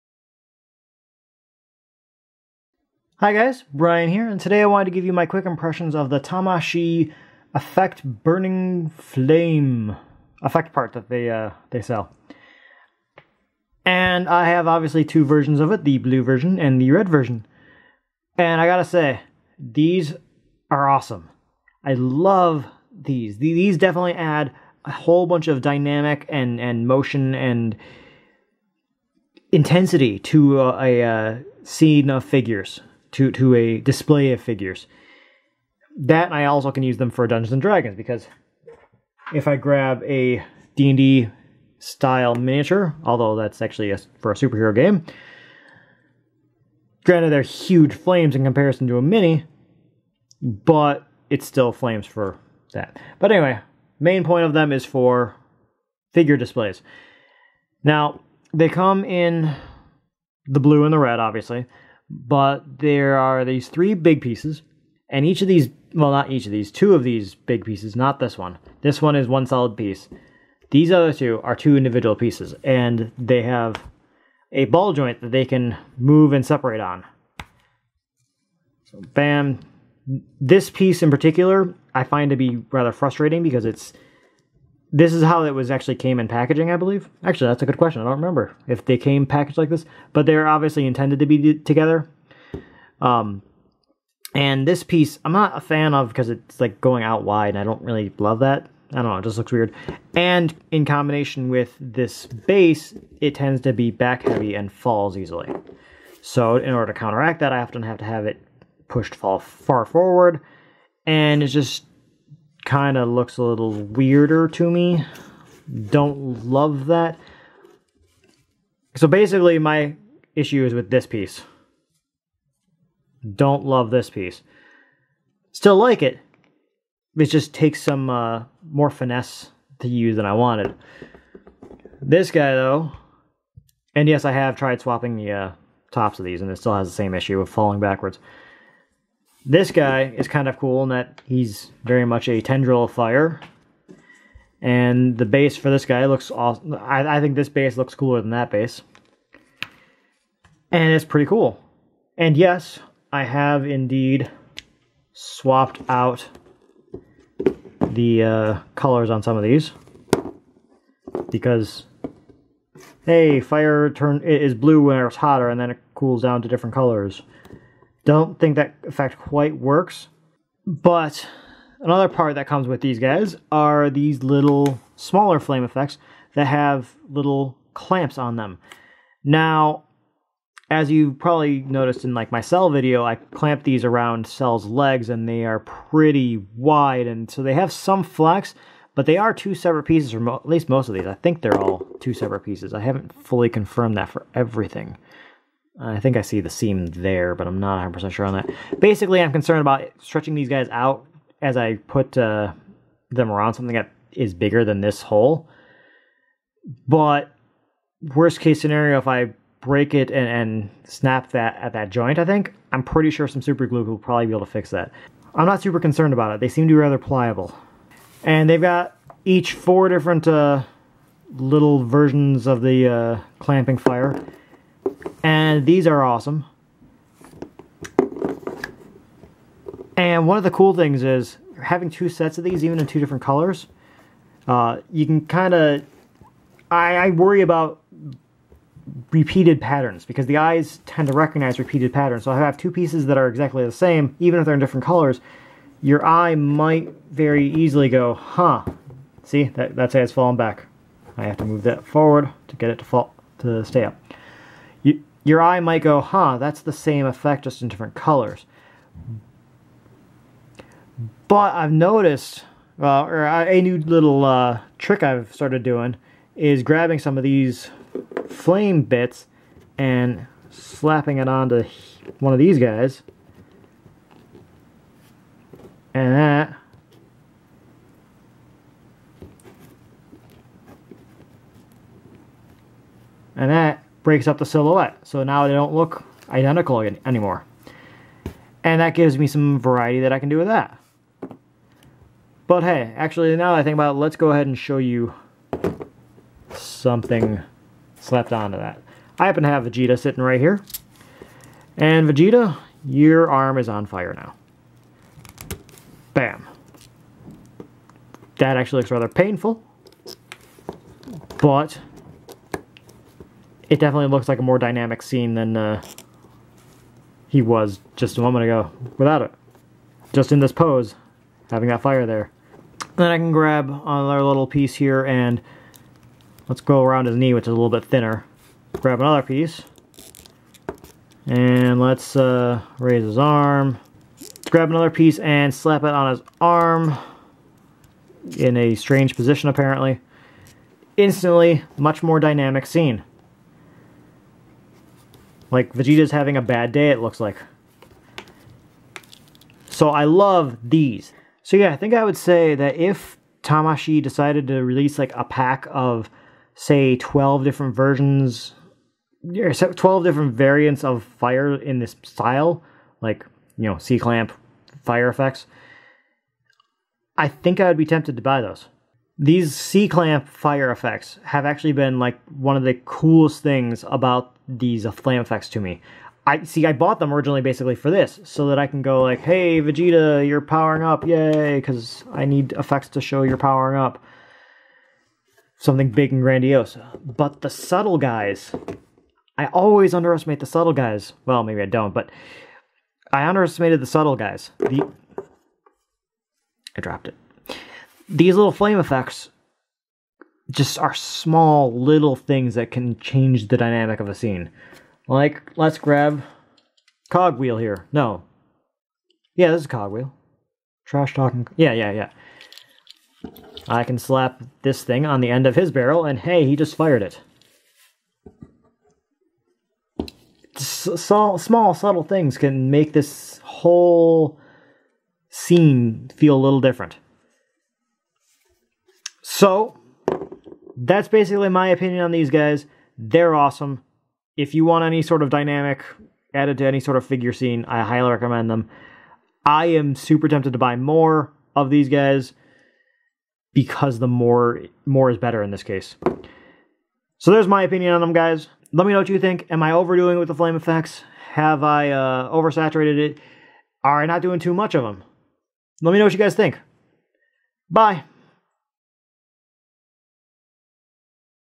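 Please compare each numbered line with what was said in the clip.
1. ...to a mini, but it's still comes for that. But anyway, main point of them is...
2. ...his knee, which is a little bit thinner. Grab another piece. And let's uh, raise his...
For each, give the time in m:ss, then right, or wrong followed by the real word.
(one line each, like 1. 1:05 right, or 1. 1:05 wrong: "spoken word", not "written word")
1. 0:48 wrong: "flames", not "comes"
2. 5:27 right.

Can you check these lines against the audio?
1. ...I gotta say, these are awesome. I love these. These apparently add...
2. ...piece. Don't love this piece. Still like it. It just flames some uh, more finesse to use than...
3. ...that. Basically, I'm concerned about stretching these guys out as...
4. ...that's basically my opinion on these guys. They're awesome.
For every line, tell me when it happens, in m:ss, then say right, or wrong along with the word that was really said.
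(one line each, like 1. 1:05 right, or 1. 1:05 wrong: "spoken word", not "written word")
1. 0:18 wrong: "definitely", not "apparently"
2. 2:01 wrong: "takes", not "flames"
3. 3:18 right
4. 7:10 right.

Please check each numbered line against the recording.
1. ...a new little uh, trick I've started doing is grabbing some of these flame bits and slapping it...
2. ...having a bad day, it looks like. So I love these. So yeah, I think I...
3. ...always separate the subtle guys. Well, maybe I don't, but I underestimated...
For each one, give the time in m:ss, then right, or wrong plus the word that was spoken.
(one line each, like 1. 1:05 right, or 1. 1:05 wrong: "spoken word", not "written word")
1. 4:23 right
2. 5:46 right
3. 6:29 wrong: "underestimate", not "separate".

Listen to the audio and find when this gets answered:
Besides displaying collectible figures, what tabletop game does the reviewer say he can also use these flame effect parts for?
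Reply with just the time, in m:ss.
0:37.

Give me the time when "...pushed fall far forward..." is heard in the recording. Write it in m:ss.
1:48.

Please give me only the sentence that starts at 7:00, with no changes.
small, small, subtle things can make this whole scene feel a little different.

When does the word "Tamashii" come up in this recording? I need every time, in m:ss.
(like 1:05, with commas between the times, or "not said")
0:06, 5:53.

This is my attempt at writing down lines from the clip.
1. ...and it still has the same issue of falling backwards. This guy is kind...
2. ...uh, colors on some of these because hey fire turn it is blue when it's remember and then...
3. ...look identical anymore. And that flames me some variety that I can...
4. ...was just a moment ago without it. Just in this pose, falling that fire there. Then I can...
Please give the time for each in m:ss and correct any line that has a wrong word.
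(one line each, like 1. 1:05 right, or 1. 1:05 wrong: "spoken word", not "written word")
1. 2:16 right
2. 2:38 wrong: "hotter", not "remember"
3. 4:45 wrong: "gives", not "flames"
4. 5:17 wrong: "having", not "falling".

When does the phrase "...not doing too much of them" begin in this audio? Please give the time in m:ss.
7:34.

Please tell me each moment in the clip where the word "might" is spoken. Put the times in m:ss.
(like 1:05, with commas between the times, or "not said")
4:06, 4:15.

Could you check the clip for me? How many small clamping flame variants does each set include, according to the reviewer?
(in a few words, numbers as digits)
4.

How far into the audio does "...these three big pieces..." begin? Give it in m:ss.
1:03.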